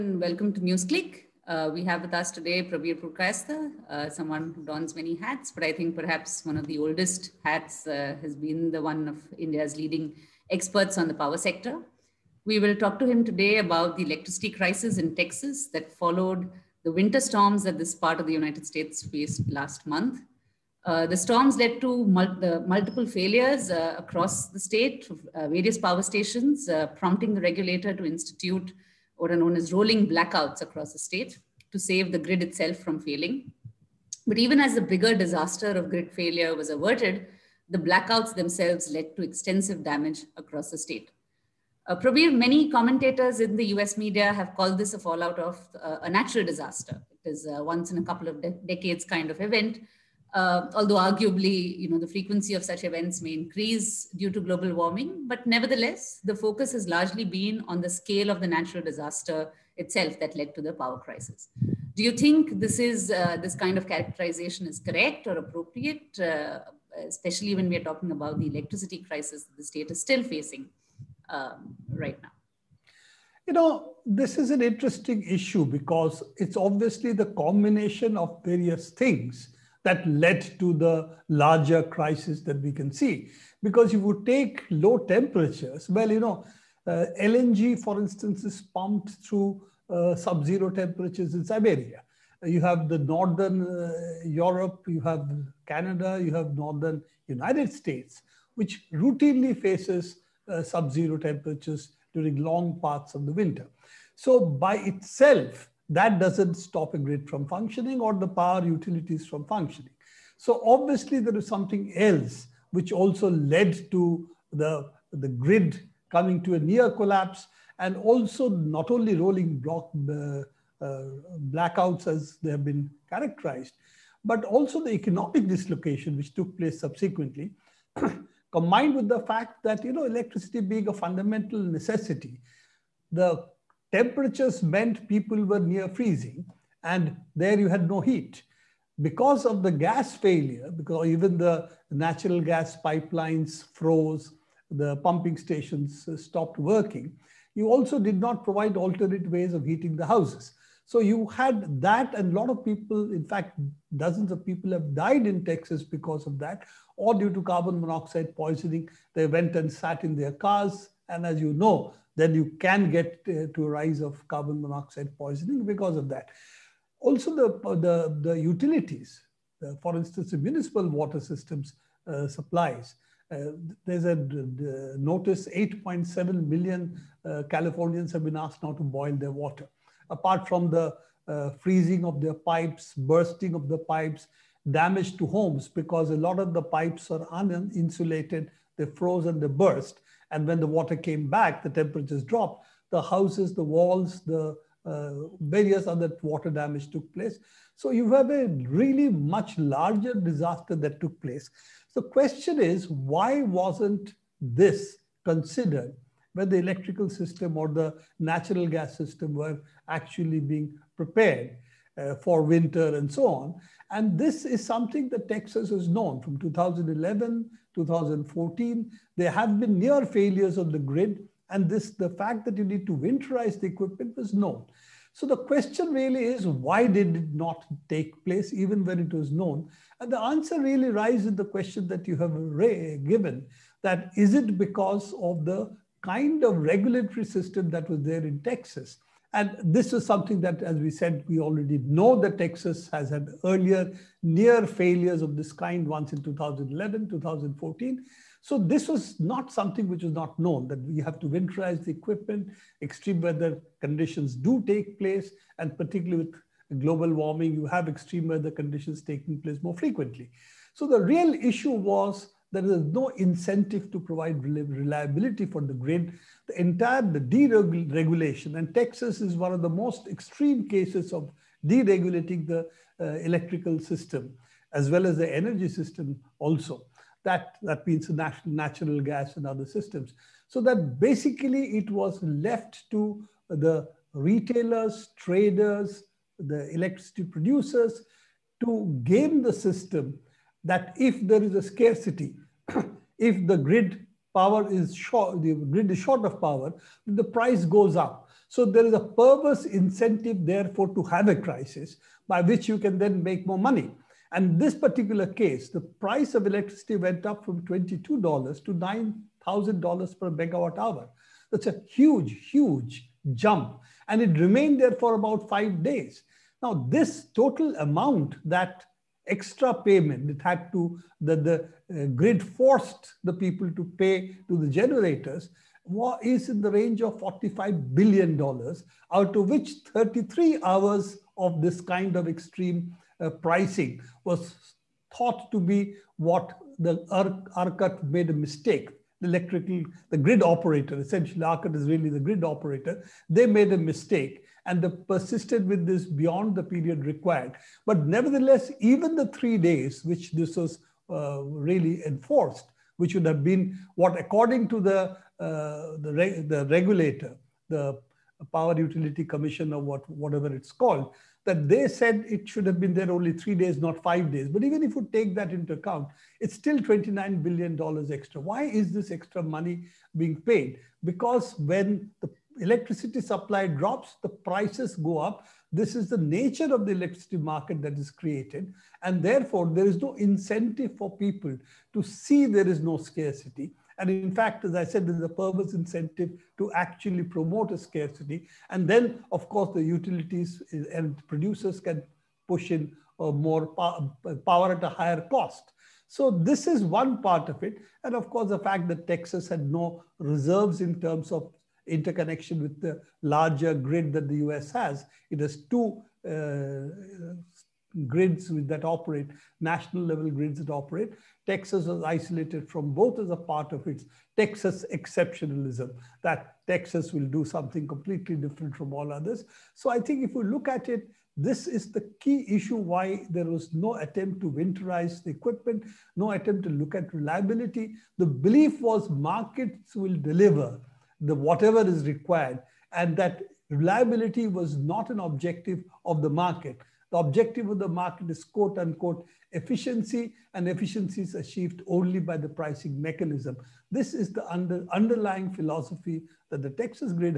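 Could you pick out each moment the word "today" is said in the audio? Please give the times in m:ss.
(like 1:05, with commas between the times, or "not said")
0:02, 0:13.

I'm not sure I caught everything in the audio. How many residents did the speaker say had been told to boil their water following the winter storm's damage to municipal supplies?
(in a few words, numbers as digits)
8.7 million.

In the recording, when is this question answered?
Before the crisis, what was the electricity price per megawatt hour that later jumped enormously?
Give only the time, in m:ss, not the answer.
5:07.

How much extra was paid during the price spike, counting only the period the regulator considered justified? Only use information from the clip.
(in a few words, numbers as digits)
$29 billion.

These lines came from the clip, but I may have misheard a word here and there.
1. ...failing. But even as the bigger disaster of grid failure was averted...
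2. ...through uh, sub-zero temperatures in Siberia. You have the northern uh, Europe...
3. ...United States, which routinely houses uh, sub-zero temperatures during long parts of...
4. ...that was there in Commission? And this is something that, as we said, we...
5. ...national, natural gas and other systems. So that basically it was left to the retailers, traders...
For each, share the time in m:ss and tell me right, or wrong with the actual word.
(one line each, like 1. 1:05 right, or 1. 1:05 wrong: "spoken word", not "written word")
1. 0:33 right
2. 1:29 right
3. 1:37 wrong: "faces", not "houses"
4. 3:57 wrong: "Texas", not "Commission"
5. 4:38 right.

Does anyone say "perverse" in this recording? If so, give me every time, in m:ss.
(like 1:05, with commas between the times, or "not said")
4:59, 6:25.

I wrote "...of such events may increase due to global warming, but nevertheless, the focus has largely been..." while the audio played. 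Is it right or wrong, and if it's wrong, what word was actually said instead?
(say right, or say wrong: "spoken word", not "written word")
right.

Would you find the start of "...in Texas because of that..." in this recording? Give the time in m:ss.
2:35.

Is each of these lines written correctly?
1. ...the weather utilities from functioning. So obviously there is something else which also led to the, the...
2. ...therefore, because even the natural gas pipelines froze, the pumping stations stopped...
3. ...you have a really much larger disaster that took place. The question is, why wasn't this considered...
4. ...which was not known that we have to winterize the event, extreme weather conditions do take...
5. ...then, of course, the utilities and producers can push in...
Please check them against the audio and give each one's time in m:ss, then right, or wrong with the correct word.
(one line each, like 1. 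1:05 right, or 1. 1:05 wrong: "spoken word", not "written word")
1. 1:48 wrong: "power", not "weather"
2. 2:20 wrong: "failure", not "therefore"
3. 3:17 right
4. 4:09 wrong: "equipment", not "event"
5. 6:28 right.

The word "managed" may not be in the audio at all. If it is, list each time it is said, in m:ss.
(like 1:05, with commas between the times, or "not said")
not said.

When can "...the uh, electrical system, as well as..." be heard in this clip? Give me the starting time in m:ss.
4:32.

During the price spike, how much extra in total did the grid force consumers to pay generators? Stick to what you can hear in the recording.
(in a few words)
$45 billion.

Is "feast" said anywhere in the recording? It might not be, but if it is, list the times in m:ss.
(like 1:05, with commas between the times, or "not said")
not said.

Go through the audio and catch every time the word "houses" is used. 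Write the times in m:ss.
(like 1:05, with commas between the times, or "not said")
2:30, 3:13.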